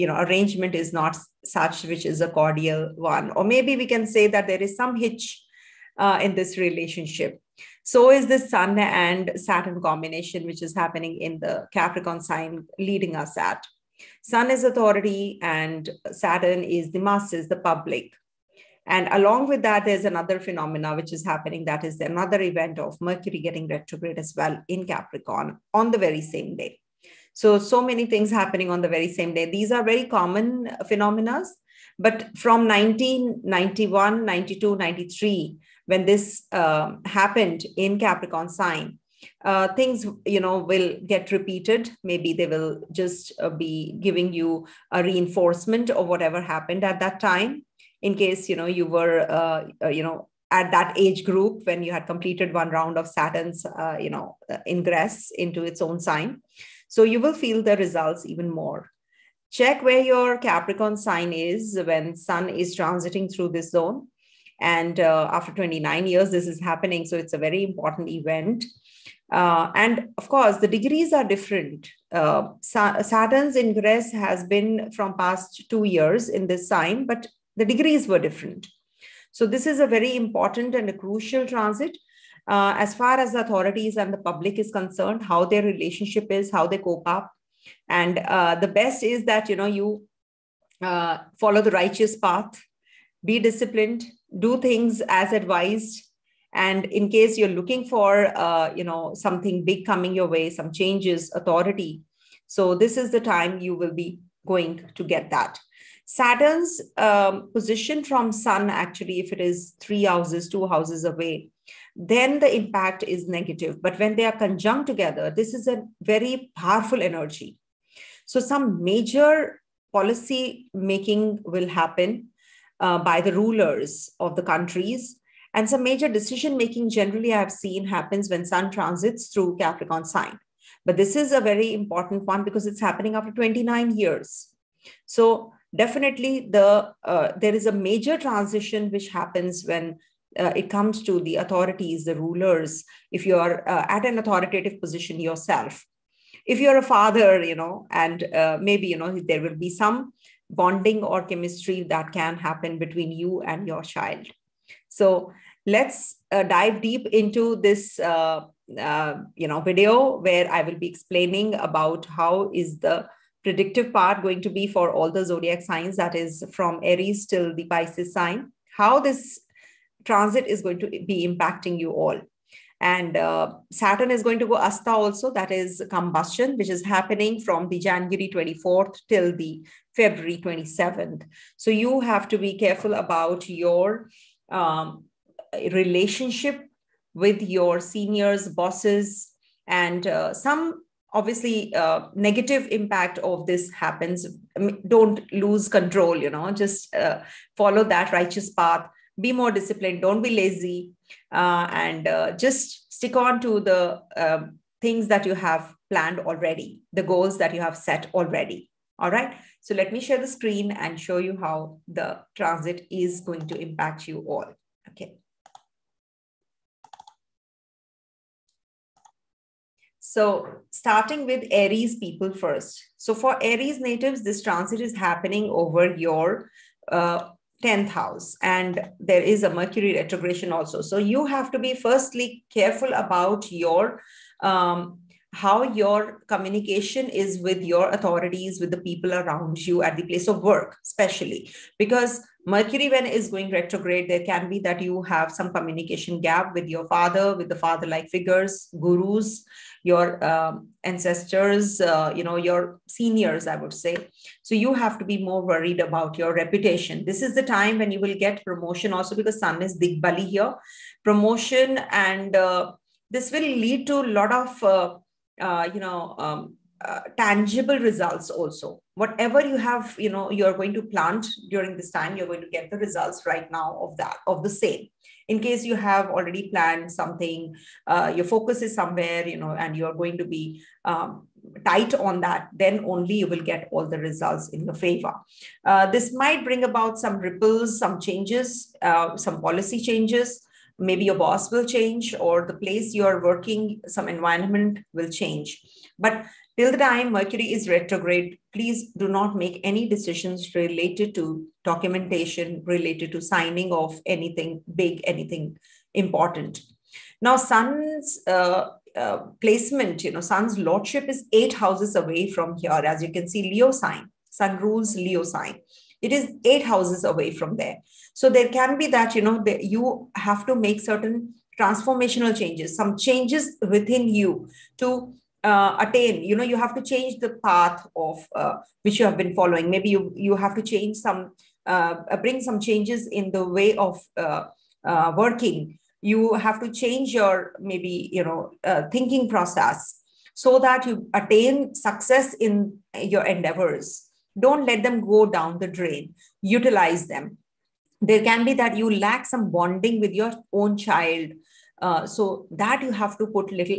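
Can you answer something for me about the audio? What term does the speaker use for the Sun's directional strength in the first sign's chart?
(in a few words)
Digbali.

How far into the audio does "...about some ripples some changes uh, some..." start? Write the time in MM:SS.
04:46.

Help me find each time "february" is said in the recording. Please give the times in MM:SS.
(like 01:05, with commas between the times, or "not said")
02:59.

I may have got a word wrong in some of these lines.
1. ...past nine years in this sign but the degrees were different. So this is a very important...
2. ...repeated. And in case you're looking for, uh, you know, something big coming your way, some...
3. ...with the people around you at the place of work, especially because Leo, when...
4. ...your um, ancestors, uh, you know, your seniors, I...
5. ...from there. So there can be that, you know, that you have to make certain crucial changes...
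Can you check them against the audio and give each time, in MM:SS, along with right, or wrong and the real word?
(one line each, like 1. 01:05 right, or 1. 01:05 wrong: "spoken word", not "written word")
1. 01:15 wrong: "two", not "nine"
2. 01:35 wrong: "advised", not "repeated"
3. 03:58 wrong: "Mercury", not "Leo"
4. 04:09 right
5. 05:17 wrong: "transformational", not "crucial".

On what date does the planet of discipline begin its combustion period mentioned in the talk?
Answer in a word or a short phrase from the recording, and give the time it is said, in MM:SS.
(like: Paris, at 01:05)
January 24th, at 02:57.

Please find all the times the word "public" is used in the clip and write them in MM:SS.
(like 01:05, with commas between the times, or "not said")
00:17, 01:24.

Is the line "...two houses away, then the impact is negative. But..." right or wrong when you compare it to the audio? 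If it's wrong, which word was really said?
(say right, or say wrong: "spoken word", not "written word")
right.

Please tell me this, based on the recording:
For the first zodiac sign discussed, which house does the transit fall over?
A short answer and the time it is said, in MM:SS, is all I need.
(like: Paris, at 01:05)
10th house, at 03:47.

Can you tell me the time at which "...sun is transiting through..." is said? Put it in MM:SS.
01:02.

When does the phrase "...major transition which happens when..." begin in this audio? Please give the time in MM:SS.
02:17.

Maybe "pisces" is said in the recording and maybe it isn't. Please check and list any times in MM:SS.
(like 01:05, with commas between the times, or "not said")
02:47.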